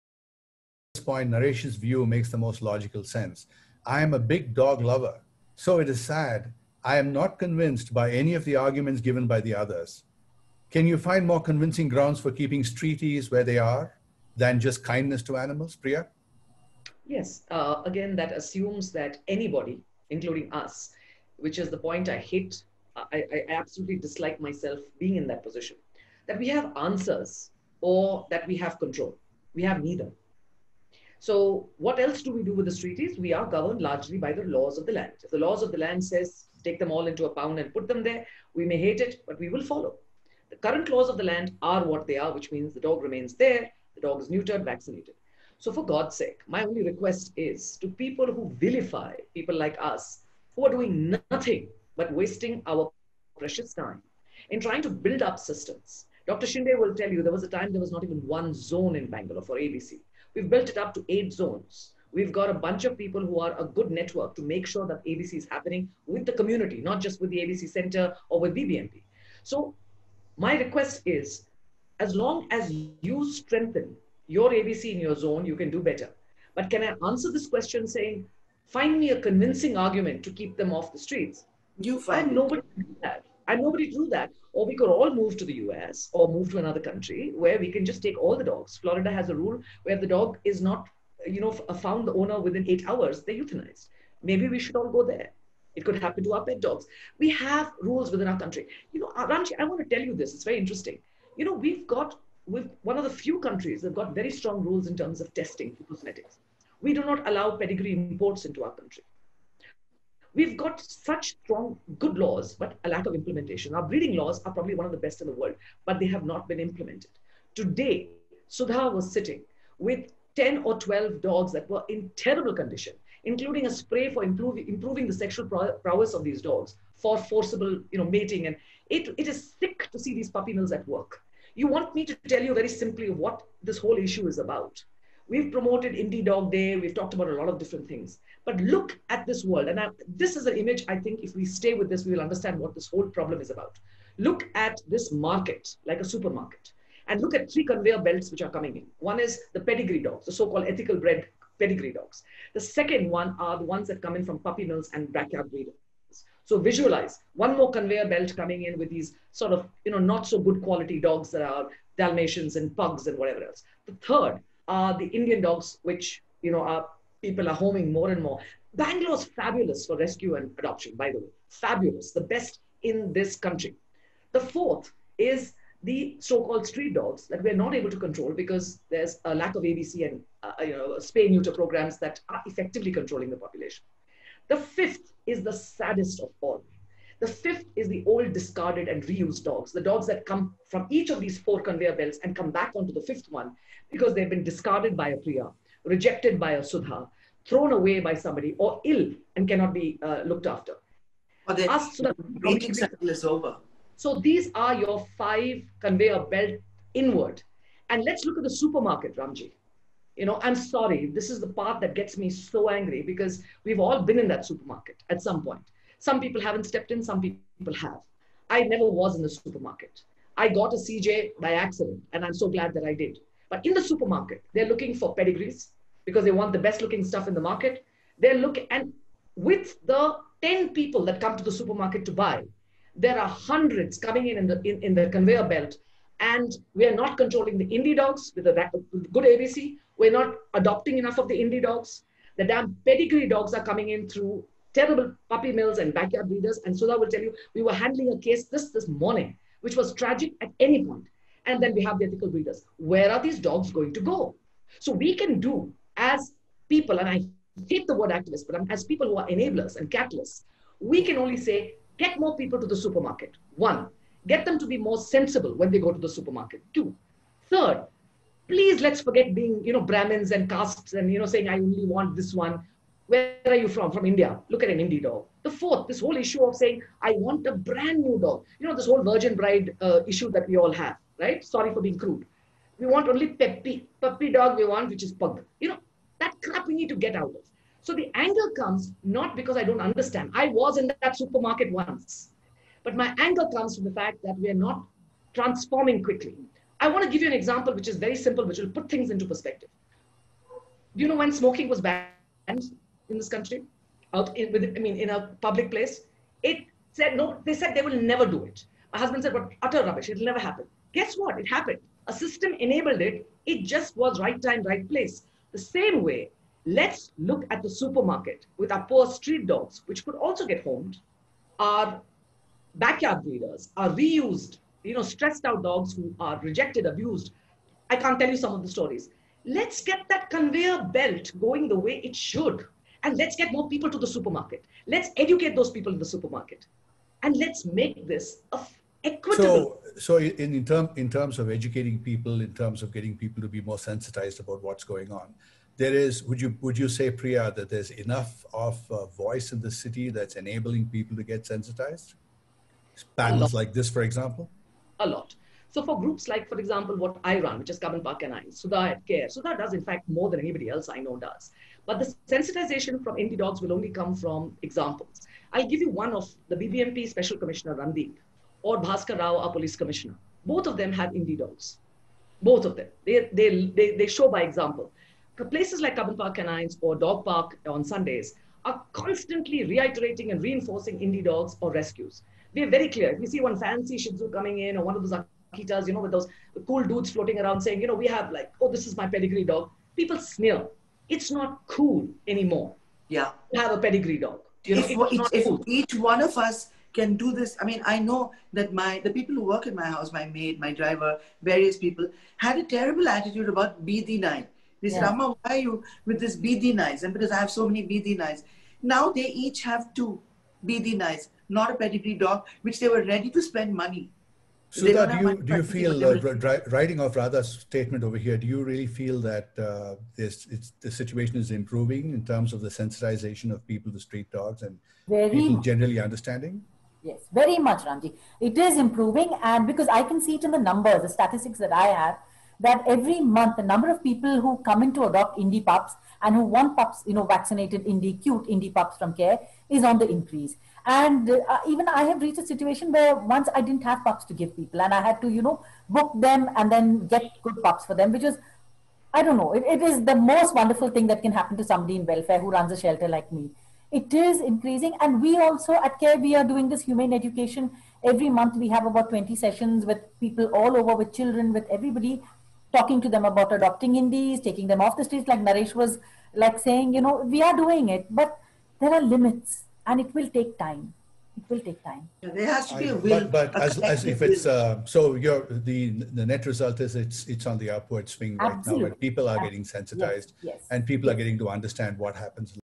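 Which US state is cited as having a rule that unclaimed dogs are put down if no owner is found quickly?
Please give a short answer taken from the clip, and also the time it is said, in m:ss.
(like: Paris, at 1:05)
Florida, at 1:28.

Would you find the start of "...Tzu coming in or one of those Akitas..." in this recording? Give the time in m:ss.
6:24.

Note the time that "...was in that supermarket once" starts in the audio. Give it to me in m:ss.
4:50.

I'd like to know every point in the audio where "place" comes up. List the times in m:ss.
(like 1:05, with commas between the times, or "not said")
5:05, 5:14, 6:15.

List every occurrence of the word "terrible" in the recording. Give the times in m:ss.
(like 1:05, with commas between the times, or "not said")
2:02, 4:04, 6:42.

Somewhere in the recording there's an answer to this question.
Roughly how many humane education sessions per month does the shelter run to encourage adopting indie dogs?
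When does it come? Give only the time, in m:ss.
7:39.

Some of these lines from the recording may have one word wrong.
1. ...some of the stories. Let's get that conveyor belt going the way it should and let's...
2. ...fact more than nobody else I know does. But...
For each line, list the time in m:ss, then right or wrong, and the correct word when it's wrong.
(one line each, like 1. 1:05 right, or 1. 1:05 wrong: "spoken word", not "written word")
1. 5:28 right
2. 5:59 wrong: "anybody", not "nobody".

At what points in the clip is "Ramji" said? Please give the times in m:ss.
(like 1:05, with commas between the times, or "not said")
1:39, 3:29, 7:07.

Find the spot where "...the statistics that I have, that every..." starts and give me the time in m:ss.
7:11.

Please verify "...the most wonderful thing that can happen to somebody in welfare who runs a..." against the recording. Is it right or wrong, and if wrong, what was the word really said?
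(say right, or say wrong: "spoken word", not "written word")
right.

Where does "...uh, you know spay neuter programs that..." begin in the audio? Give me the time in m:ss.
3:00.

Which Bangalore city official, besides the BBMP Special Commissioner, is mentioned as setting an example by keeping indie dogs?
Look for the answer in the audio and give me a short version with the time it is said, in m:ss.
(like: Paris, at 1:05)
Bhaskar Rao, at 6:08.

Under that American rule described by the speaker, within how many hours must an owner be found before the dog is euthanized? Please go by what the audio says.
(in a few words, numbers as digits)
8.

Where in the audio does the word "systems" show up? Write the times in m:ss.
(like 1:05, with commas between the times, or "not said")
0:55, 5:12.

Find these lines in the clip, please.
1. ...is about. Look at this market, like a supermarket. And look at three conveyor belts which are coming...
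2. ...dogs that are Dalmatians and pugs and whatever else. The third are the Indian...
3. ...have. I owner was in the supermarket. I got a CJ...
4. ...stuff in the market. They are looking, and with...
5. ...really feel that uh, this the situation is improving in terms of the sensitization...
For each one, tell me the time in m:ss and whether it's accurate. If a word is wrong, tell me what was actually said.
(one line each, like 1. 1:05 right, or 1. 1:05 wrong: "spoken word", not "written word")
1. 2:23 right
2. 2:40 right
3. 3:37 wrong: "never", not "owner"
4. 3:47 right
5. 6:58 right.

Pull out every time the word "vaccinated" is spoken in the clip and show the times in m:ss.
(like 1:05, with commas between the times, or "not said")
0:44, 7:17.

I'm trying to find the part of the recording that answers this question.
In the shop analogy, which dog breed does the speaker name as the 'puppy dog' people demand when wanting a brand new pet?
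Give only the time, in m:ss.
4:45.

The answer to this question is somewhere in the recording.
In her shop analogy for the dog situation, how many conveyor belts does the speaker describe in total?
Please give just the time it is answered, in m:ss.
3:25.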